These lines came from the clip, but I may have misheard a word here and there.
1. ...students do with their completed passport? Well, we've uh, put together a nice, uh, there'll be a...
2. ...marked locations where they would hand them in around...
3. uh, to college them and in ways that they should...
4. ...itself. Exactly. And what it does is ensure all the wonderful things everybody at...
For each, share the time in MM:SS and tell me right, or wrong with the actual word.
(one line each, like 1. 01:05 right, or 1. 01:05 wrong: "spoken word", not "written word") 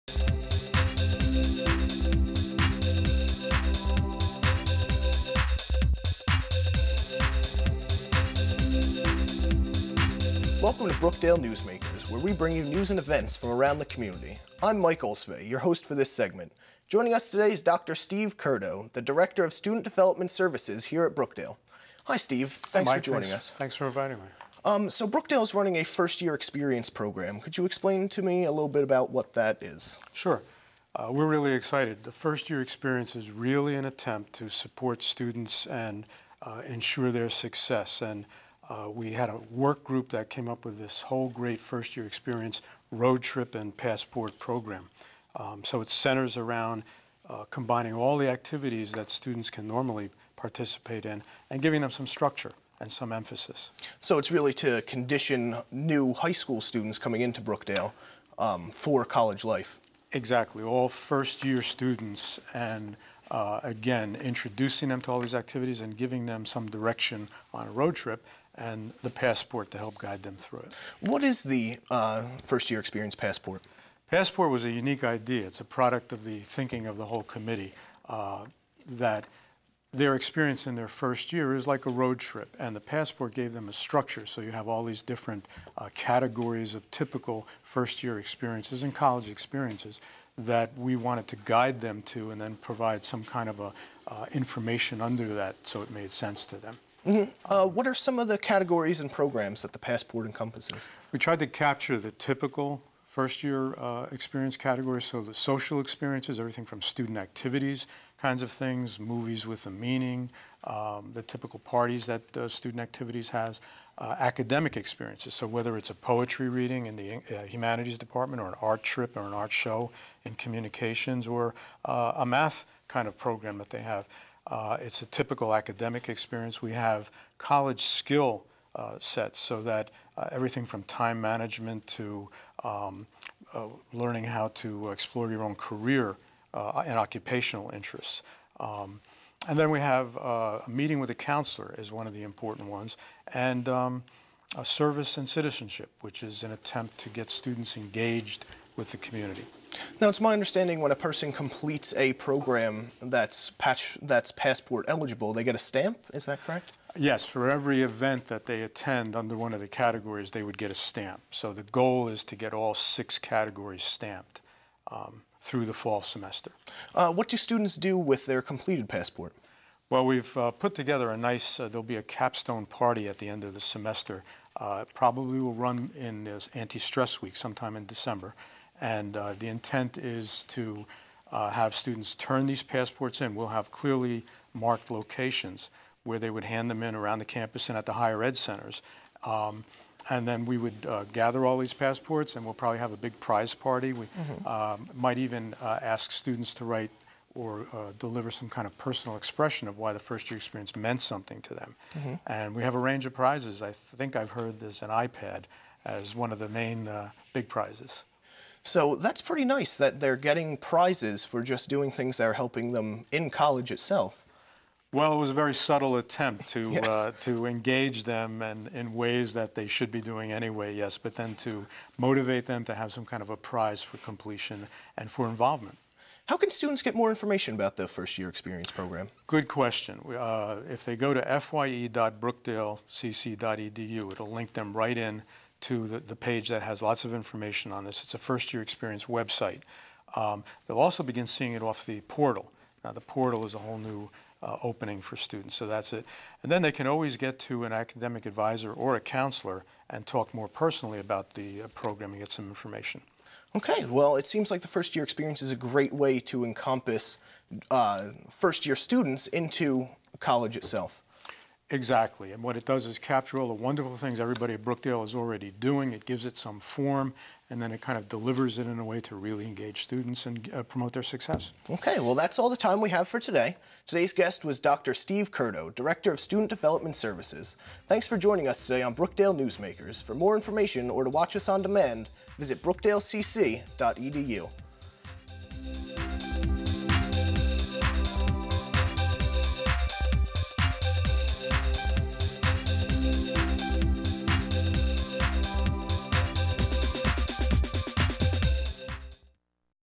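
1. 02:47 right
2. 03:04 right
3. 03:36 wrong: "engage", not "college"
4. 04:20 wrong: "capture", not "ensure".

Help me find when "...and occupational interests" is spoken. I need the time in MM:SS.
02:16.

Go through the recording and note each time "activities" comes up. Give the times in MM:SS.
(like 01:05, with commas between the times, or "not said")
00:48, 01:05, 01:47, 01:52.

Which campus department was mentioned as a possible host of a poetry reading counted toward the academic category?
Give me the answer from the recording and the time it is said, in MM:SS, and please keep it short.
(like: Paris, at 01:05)
Humanities, at 01:57.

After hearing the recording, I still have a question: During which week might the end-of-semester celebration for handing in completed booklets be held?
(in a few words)
Anti-stress week.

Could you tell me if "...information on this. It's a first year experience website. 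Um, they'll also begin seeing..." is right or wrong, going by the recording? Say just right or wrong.
right.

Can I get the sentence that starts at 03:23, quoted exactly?
I think I've heard there's an iPad as one of the main uh, big prizes.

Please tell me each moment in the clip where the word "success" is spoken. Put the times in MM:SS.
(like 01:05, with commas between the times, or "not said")
00:37, 04:31.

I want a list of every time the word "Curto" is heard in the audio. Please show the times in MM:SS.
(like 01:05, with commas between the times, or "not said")
00:18, 04:35.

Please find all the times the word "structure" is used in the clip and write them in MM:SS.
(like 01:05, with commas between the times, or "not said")
00:52, 01:23.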